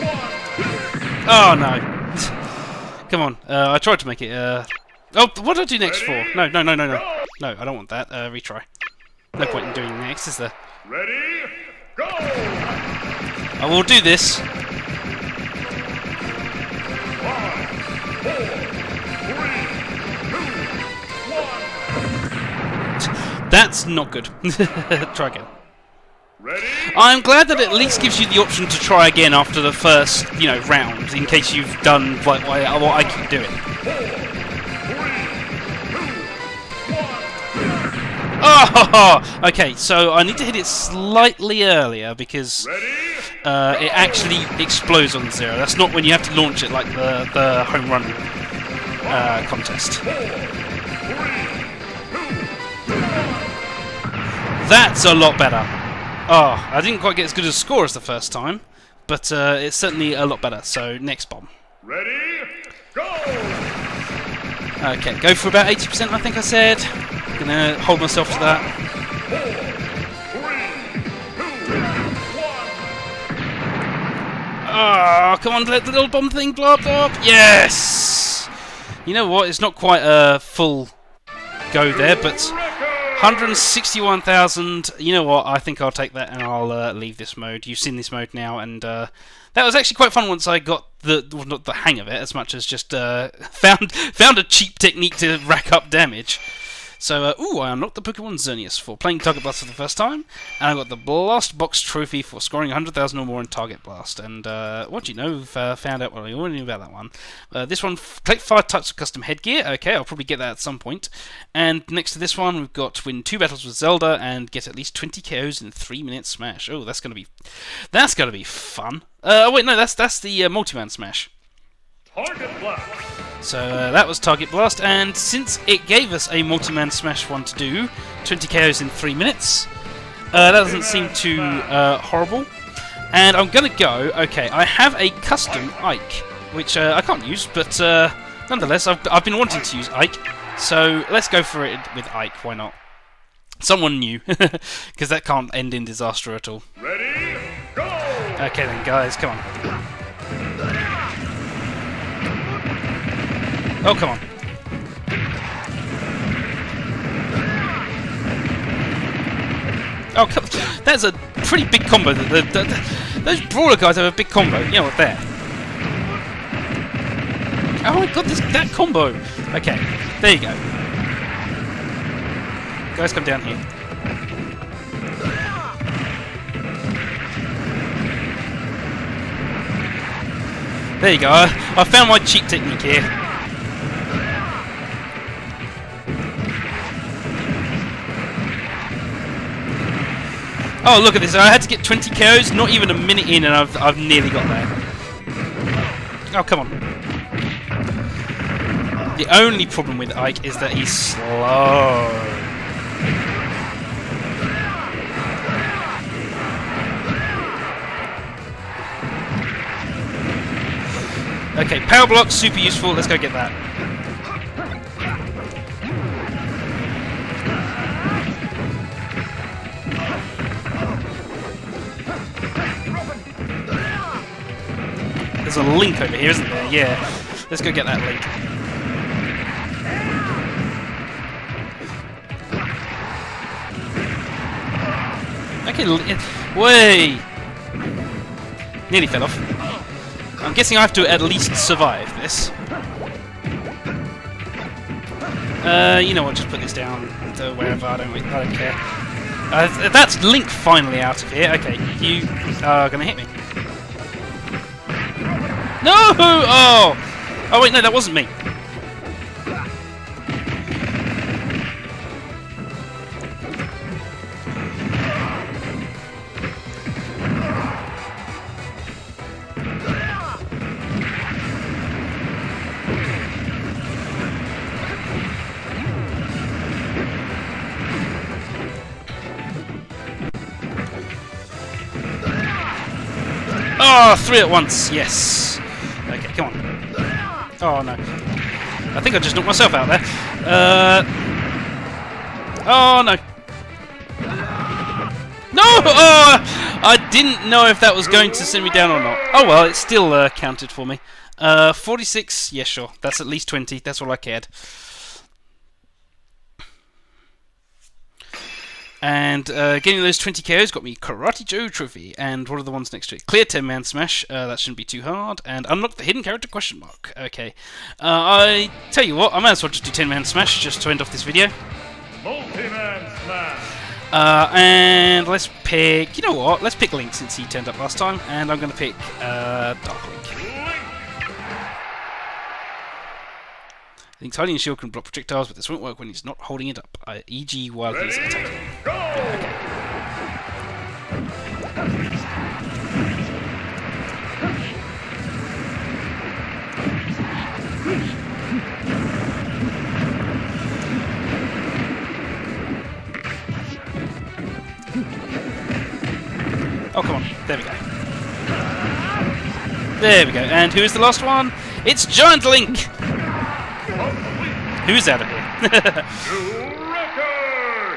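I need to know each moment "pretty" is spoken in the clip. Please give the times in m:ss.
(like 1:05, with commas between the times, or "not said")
2:41.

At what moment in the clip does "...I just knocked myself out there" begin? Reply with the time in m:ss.
4:49.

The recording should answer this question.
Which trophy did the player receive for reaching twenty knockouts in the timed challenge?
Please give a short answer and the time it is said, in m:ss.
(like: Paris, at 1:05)
Karate Joe Trophy, at 5:10.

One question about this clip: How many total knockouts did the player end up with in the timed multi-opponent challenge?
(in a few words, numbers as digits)
46.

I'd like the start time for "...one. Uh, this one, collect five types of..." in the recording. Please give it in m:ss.
1:46.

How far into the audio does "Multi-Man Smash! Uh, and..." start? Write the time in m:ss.
5:22.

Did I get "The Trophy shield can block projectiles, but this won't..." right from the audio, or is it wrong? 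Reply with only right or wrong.
wrong.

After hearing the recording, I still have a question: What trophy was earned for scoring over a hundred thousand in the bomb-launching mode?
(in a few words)
Blast Box Trophy.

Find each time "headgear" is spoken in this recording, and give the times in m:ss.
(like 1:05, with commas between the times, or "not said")
1:49.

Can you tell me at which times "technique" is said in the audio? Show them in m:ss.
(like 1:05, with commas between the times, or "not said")
1:34, 3:02.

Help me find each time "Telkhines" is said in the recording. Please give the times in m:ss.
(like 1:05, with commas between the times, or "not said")
not said.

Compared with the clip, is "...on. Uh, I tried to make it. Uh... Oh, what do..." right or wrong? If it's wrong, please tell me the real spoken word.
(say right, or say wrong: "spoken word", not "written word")
right.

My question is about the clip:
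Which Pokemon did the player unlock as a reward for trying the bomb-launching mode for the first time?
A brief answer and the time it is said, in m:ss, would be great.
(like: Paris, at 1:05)
Xerneas, at 1:38.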